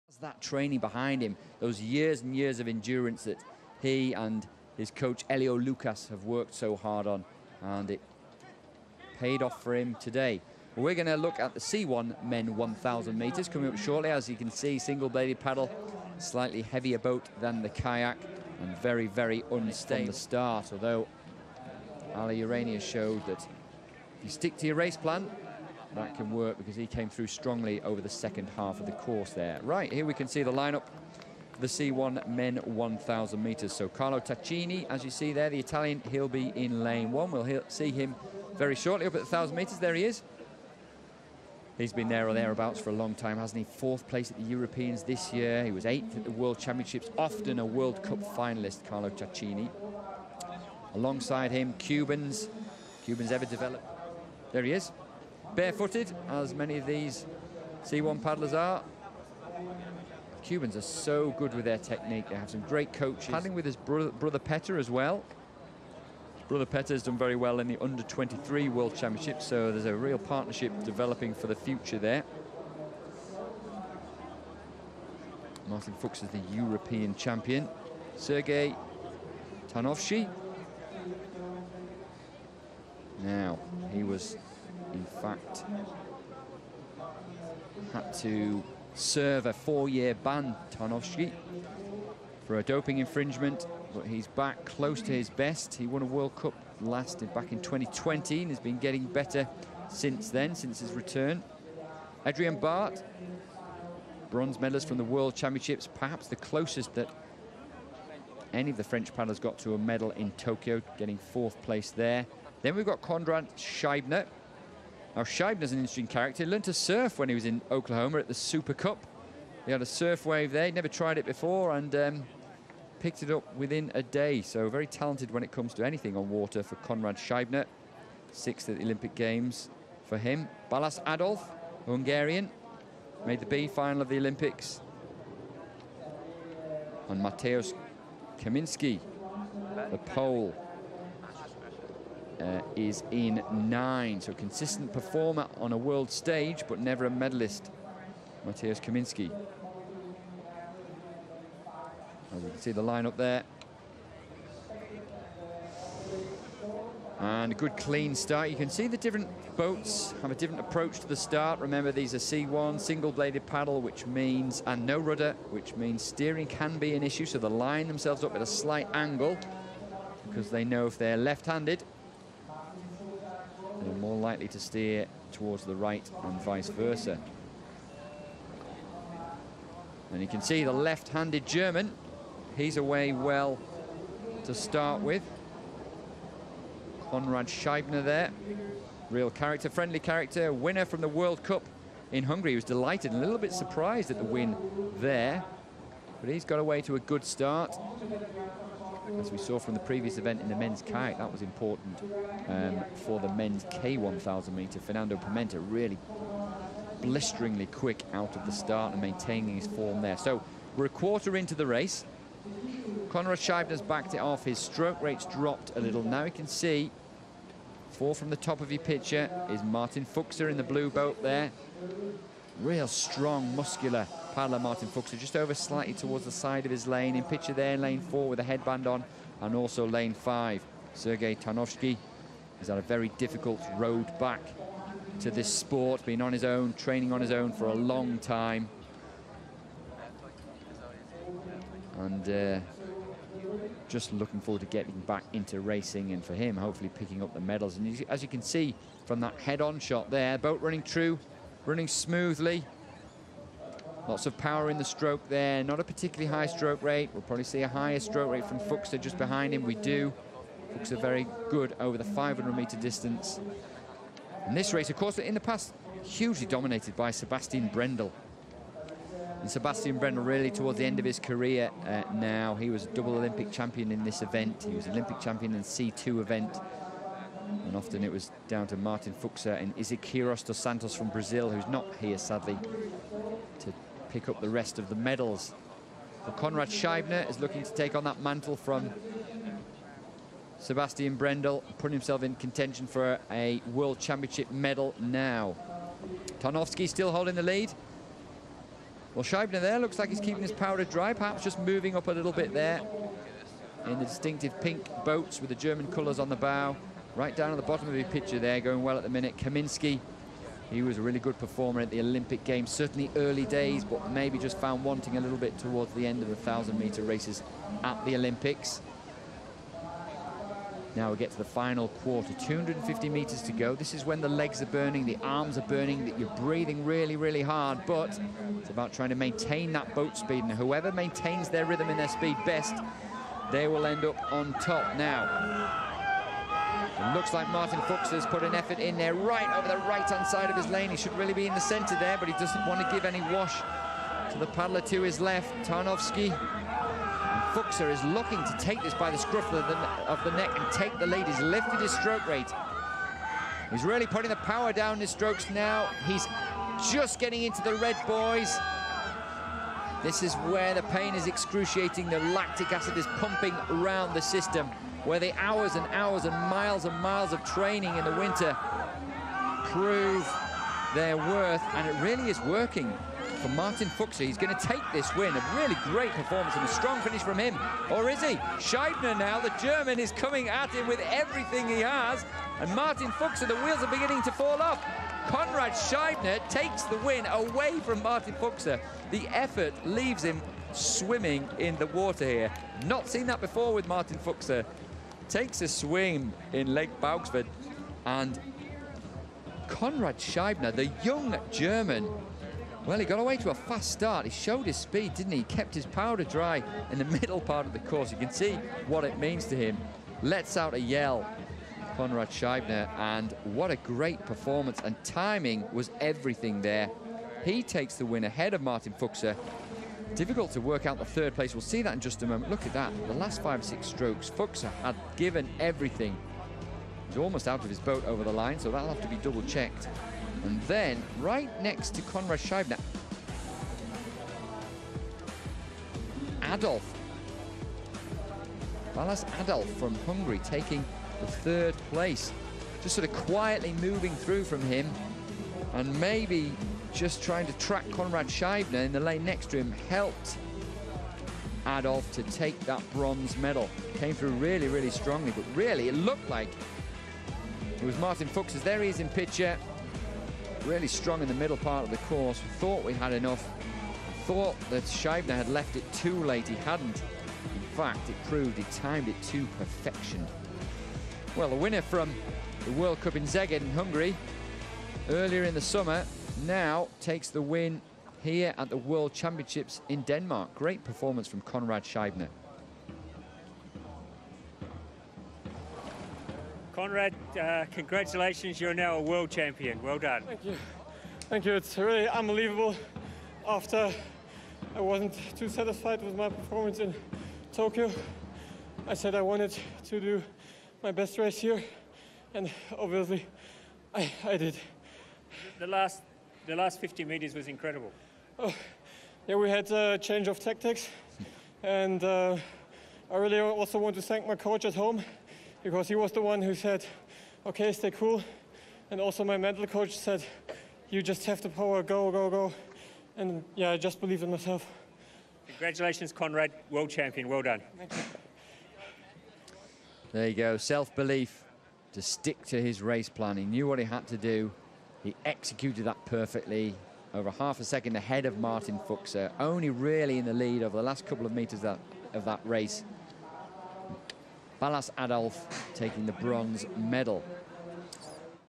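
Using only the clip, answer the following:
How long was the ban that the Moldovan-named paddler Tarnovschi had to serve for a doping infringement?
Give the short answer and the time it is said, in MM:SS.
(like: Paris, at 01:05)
4 years, at 01:29.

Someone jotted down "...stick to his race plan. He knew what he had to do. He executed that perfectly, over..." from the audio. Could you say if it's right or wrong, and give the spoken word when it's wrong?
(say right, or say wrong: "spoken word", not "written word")
right.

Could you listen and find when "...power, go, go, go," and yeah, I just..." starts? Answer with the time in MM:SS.
08:41.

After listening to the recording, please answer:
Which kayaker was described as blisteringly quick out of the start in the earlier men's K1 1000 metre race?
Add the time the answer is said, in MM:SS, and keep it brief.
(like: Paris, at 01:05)
Fernando Pimenta, at 03:24.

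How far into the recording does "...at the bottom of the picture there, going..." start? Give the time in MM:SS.
05:07.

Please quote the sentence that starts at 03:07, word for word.
Conrad Scheibner there, real character, friendly character, winner from the World Cup in Hungary.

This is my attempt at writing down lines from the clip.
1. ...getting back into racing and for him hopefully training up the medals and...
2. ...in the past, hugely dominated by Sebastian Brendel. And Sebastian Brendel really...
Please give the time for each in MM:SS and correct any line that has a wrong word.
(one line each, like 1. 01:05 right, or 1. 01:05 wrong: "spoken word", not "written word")
1. 04:04 wrong: "picking", not "training"
2. 04:25 right.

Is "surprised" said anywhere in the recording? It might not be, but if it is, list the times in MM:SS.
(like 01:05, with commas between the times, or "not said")
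03:13.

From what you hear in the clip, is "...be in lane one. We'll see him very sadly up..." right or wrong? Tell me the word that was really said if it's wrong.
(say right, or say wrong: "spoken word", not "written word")
wrong: "shortly", not "sadly".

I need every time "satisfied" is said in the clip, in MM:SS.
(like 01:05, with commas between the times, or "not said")
08:15.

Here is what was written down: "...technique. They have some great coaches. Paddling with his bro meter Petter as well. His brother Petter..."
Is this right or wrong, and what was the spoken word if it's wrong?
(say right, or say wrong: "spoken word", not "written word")
wrong: "brother", not "meter".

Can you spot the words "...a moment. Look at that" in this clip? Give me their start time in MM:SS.
07:02.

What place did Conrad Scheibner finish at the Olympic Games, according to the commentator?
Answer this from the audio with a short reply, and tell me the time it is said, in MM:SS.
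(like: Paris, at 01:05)
Sixth, at 02:08.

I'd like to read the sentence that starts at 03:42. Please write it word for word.
Real strong, muscular paddler, Martin Fuksa, just over slightly towards the side of his lane.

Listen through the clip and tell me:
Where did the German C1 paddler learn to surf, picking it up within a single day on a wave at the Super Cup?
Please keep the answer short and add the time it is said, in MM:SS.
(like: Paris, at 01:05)
Oklahoma, at 01:57.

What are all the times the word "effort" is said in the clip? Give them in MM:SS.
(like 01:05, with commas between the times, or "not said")
05:38, 06:29.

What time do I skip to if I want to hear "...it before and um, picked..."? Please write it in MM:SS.
02:01.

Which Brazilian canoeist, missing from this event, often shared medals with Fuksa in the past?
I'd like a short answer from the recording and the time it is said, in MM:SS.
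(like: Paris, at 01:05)
Isaquias dos Santos, at 04:39.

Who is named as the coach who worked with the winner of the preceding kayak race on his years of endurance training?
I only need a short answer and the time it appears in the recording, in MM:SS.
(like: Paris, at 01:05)
Elio Lucas, at 00:05.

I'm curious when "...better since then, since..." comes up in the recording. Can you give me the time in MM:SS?
01:39.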